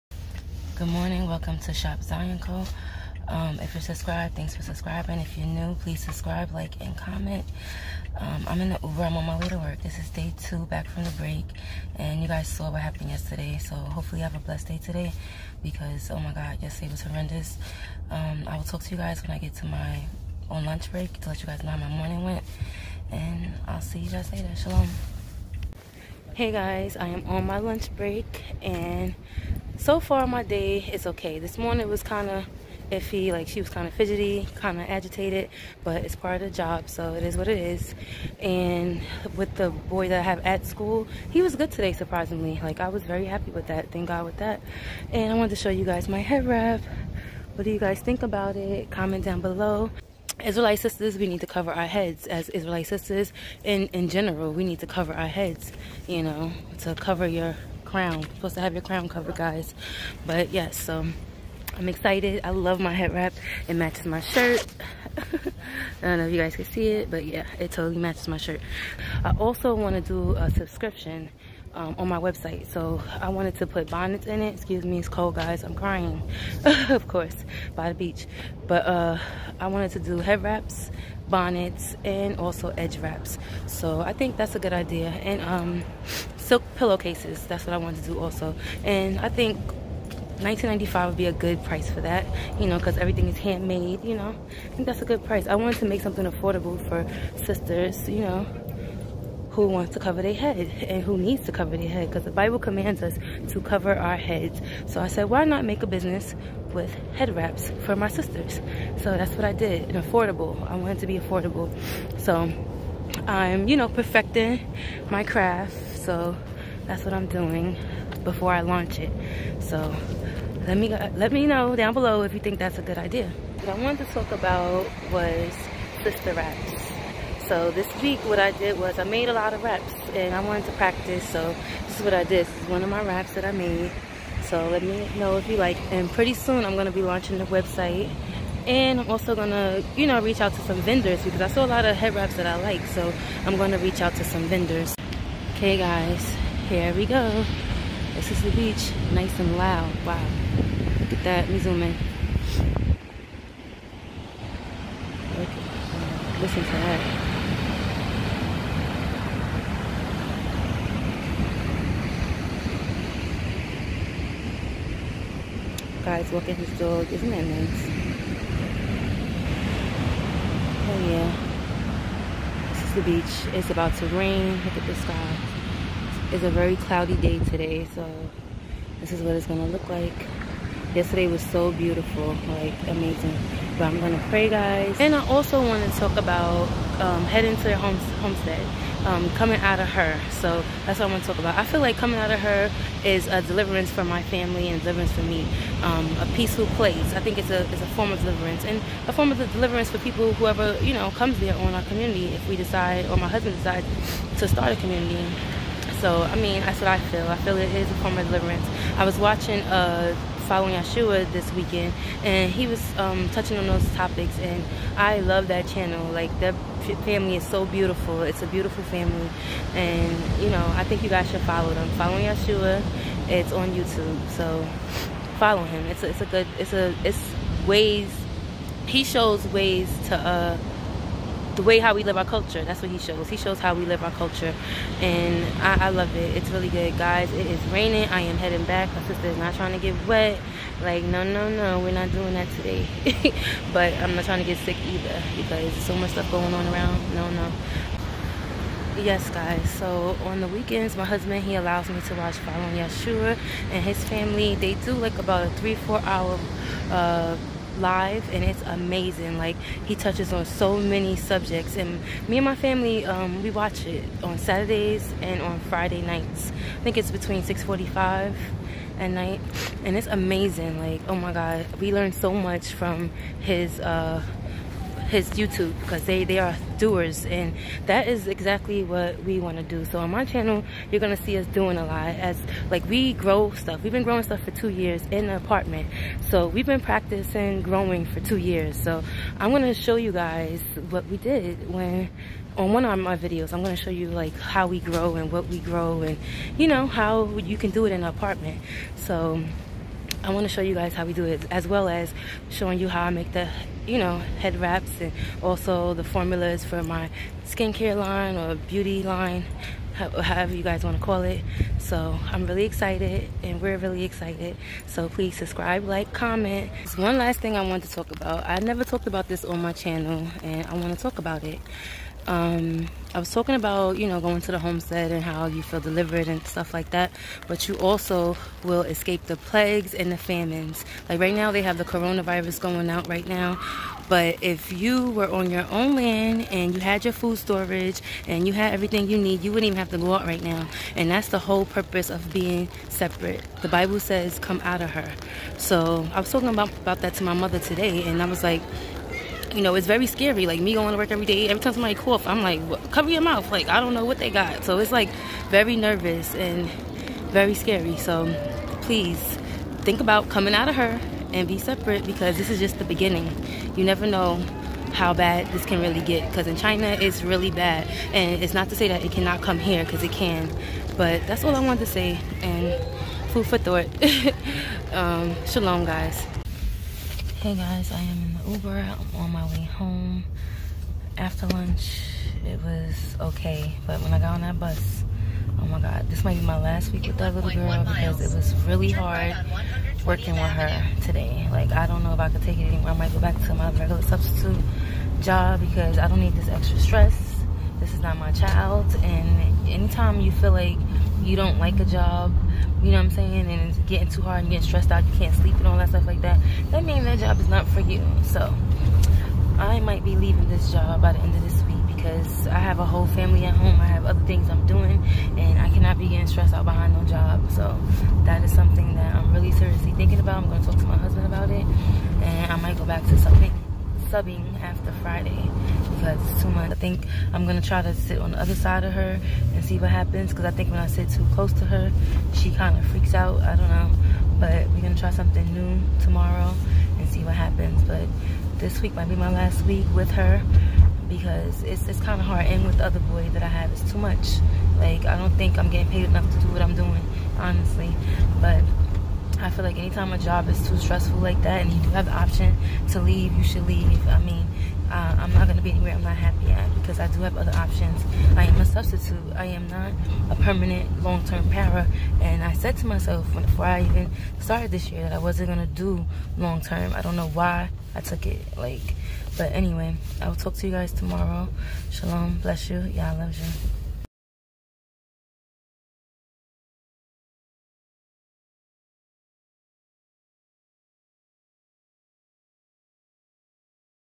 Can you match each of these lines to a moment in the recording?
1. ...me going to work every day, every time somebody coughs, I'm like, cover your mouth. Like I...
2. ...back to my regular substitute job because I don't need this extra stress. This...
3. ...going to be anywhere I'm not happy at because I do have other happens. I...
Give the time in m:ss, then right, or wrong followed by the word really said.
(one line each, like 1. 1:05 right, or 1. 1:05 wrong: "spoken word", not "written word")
1. 5:50 right
2. 6:33 right
3. 7:35 wrong: "options", not "happens".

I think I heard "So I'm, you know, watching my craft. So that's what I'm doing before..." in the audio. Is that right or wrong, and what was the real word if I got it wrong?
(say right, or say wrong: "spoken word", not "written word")
wrong: "perfecting", not "watching".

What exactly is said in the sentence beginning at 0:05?
If you're new, please subscribe, like, and comment.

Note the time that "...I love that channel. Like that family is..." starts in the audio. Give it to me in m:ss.
3:34.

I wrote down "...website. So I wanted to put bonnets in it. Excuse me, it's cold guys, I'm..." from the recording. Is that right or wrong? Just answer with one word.
right.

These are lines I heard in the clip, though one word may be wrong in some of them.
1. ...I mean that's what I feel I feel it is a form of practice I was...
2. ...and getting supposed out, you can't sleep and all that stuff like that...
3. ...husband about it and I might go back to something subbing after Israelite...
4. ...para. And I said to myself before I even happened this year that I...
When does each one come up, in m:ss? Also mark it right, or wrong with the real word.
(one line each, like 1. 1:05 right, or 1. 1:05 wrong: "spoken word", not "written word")
1. 3:26 wrong: "deliverance", not "practice"
2. 6:44 wrong: "stressed", not "supposed"
3. 7:00 wrong: "Friday", not "Israelite"
4. 7:41 wrong: "started", not "happened".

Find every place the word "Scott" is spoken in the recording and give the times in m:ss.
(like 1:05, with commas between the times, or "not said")
not said.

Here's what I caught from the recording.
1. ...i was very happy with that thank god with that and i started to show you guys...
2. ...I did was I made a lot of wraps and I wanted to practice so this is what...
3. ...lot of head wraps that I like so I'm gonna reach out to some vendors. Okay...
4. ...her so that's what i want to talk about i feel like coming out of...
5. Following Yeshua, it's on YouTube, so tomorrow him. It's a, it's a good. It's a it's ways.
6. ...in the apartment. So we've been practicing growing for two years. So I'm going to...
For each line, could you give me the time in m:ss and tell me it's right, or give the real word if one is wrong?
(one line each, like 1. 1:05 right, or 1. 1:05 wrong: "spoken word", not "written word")
1. 0:42 wrong: "wanted", not "started"
2. 2:08 right
3. 2:21 right
4. 3:09 right
5. 3:41 wrong: "follow", not "tomorrow"
6. 4:45 right.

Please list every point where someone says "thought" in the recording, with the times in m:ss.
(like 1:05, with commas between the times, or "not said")
6:13.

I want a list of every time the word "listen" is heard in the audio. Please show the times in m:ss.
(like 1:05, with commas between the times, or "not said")
2:36.